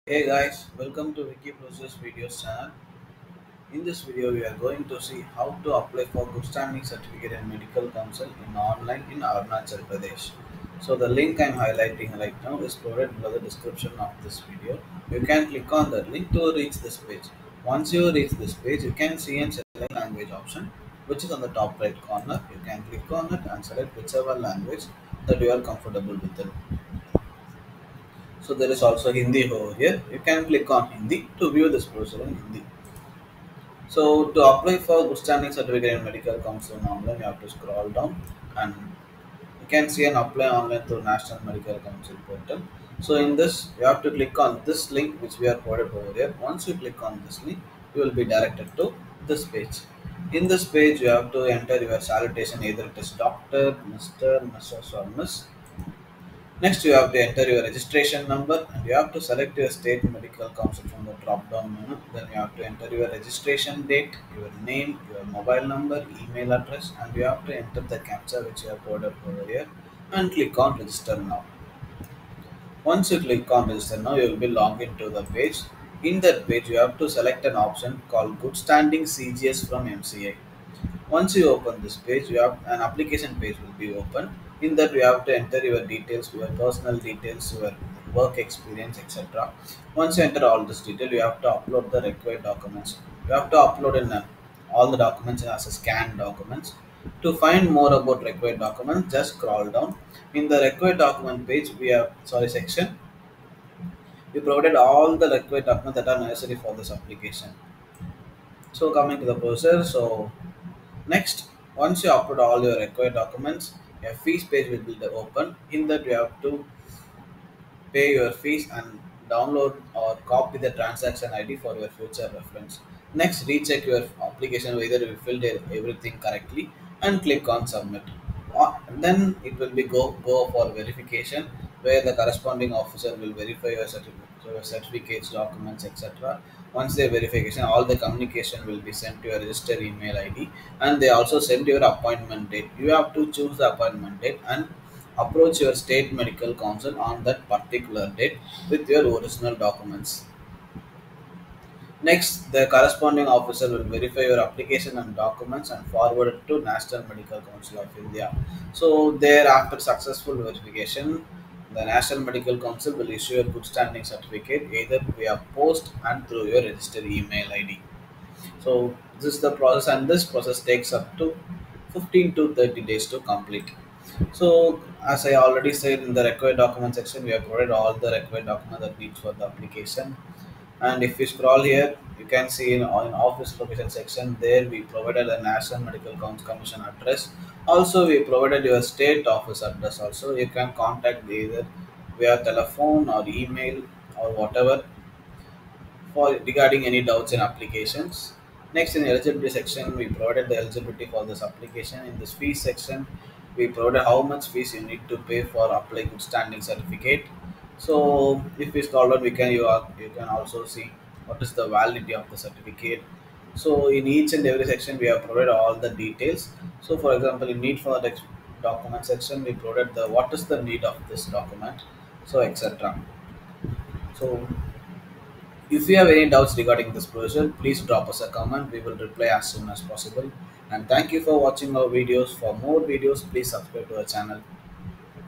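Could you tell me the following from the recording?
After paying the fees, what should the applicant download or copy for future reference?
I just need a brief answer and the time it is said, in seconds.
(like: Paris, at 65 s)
Transaction ID, at 120 s.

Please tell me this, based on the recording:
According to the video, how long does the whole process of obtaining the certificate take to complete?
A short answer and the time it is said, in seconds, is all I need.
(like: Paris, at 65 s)
15 to 30 days, at 171 s.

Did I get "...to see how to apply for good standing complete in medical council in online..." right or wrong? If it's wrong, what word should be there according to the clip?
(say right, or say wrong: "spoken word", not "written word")
wrong: "certificate", not "complete".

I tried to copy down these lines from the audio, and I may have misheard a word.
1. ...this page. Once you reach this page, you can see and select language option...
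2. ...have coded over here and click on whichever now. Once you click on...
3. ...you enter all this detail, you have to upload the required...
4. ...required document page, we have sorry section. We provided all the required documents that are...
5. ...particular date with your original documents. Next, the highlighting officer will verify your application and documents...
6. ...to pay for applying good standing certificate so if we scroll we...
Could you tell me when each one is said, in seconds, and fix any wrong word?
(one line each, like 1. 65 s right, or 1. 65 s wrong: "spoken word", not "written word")
1. 16 s right
2. 68 s wrong: "register", not "whichever"
3. 90 s right
4. 100 s right
5. 147 s wrong: "corresponding", not "highlighting"
6. 205 s right.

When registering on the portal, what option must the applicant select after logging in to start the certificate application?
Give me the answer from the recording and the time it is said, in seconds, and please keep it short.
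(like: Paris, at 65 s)
Good standing CGS from MCA, at 78 s.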